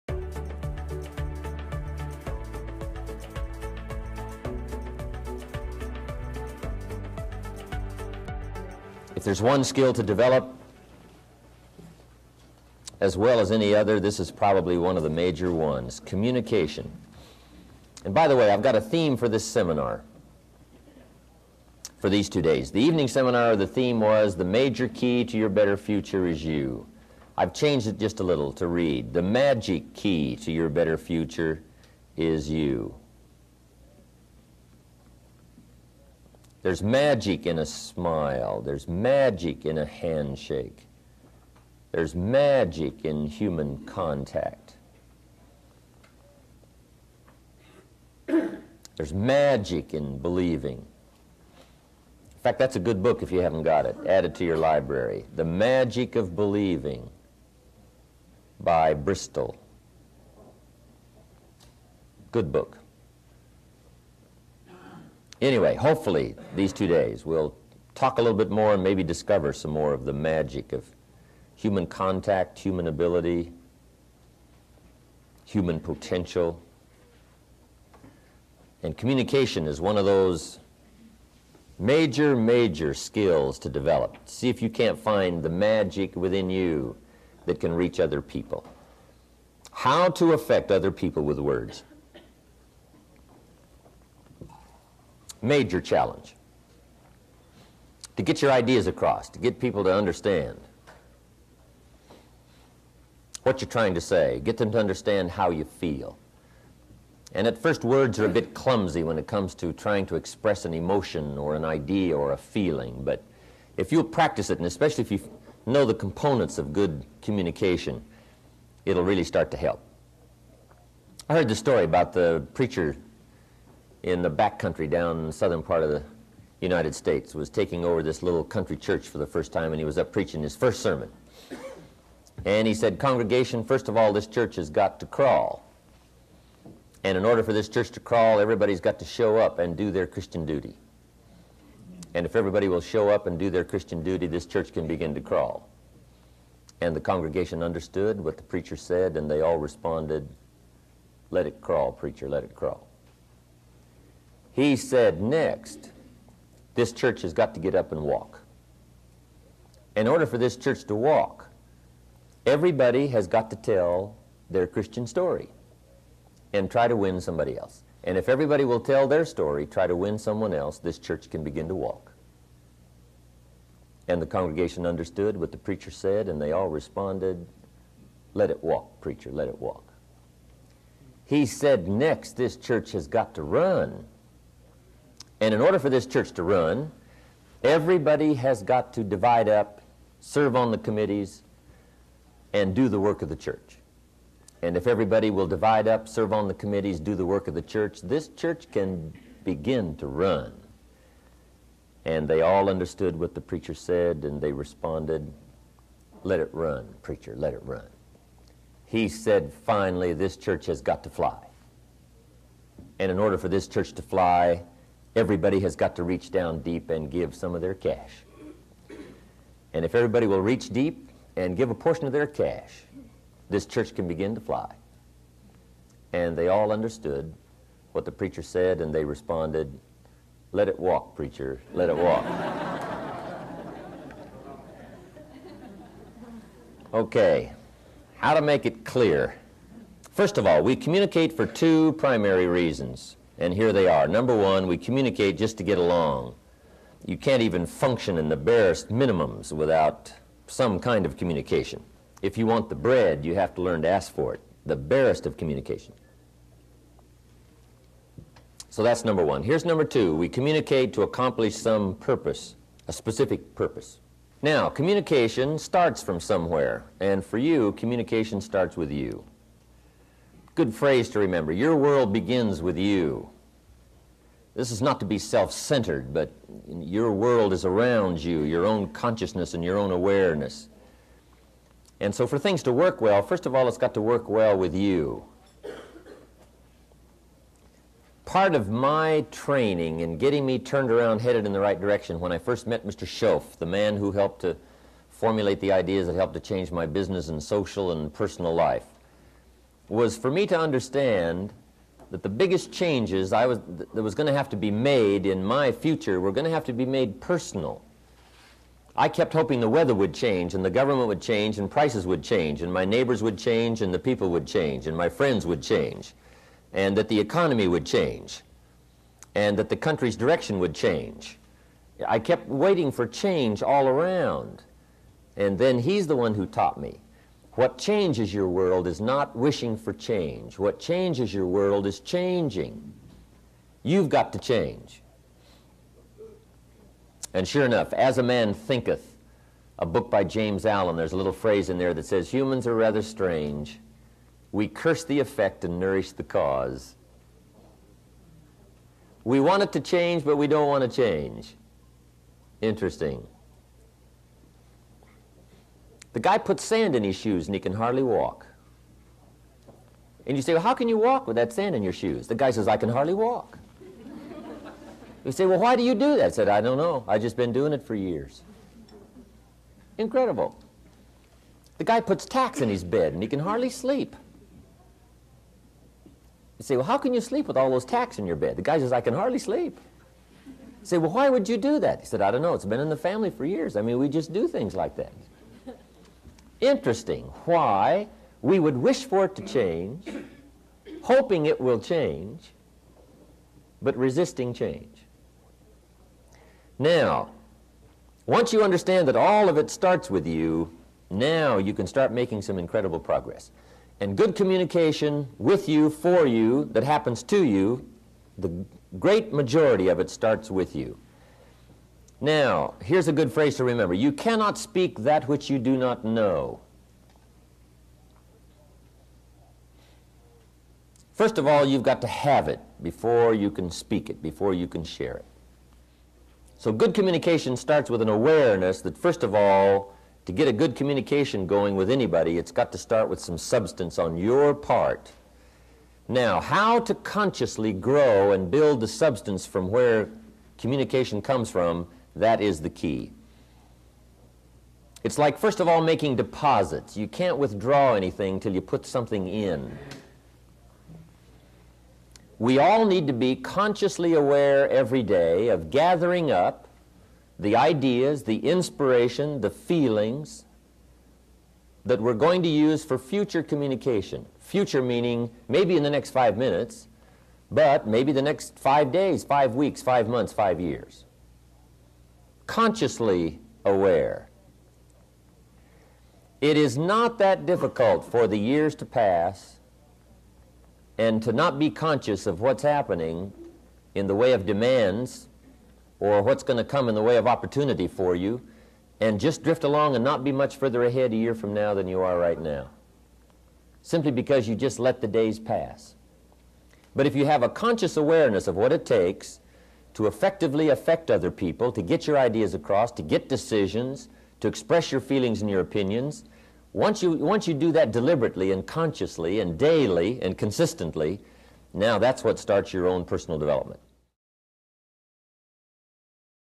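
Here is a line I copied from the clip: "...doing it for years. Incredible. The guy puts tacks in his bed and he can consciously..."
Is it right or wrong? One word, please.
wrong.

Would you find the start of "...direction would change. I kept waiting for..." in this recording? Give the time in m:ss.
5:20.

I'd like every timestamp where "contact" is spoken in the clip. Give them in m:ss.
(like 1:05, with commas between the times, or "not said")
0:43, 1:11.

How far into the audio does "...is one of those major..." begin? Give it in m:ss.
1:19.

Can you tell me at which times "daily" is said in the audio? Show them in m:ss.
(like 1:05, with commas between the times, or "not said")
8:29.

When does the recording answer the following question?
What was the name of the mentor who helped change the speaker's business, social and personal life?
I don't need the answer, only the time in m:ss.
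4:52.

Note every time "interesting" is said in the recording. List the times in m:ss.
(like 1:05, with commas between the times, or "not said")
5:52, 6:26.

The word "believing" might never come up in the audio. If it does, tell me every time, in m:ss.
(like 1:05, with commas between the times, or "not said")
0:50, 0:56.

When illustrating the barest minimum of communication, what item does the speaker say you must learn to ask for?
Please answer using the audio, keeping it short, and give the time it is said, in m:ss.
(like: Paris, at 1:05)
The bread, at 4:12.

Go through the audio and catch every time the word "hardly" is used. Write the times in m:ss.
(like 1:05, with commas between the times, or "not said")
5:57, 6:02, 6:13, 6:19.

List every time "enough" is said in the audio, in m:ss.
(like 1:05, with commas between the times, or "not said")
5:37.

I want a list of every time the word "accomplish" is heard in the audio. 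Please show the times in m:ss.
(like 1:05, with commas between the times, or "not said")
4:21.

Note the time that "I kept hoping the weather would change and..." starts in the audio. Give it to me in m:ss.
5:08.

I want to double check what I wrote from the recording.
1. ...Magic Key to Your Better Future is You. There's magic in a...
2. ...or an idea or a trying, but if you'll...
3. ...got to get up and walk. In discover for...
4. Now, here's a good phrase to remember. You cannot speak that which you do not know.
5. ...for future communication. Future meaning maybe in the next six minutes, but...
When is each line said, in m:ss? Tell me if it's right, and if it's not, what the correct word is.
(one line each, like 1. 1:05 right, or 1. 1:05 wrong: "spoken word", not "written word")
1. 0:29 right
2. 1:51 wrong: "feeling", not "trying"
3. 2:37 wrong: "order", not "discover"
4. 6:52 right
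5. 7:42 wrong: "five", not "six".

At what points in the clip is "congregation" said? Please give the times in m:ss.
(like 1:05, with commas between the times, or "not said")
2:12, 2:26, 2:54.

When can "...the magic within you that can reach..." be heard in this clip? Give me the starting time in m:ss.
1:25.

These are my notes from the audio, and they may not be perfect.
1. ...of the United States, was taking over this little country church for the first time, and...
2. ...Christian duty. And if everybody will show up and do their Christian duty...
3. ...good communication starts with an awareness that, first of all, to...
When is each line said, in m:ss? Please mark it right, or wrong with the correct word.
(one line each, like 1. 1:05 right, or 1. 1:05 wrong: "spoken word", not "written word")
1. 2:05 right
2. 2:20 right
3. 7:06 right.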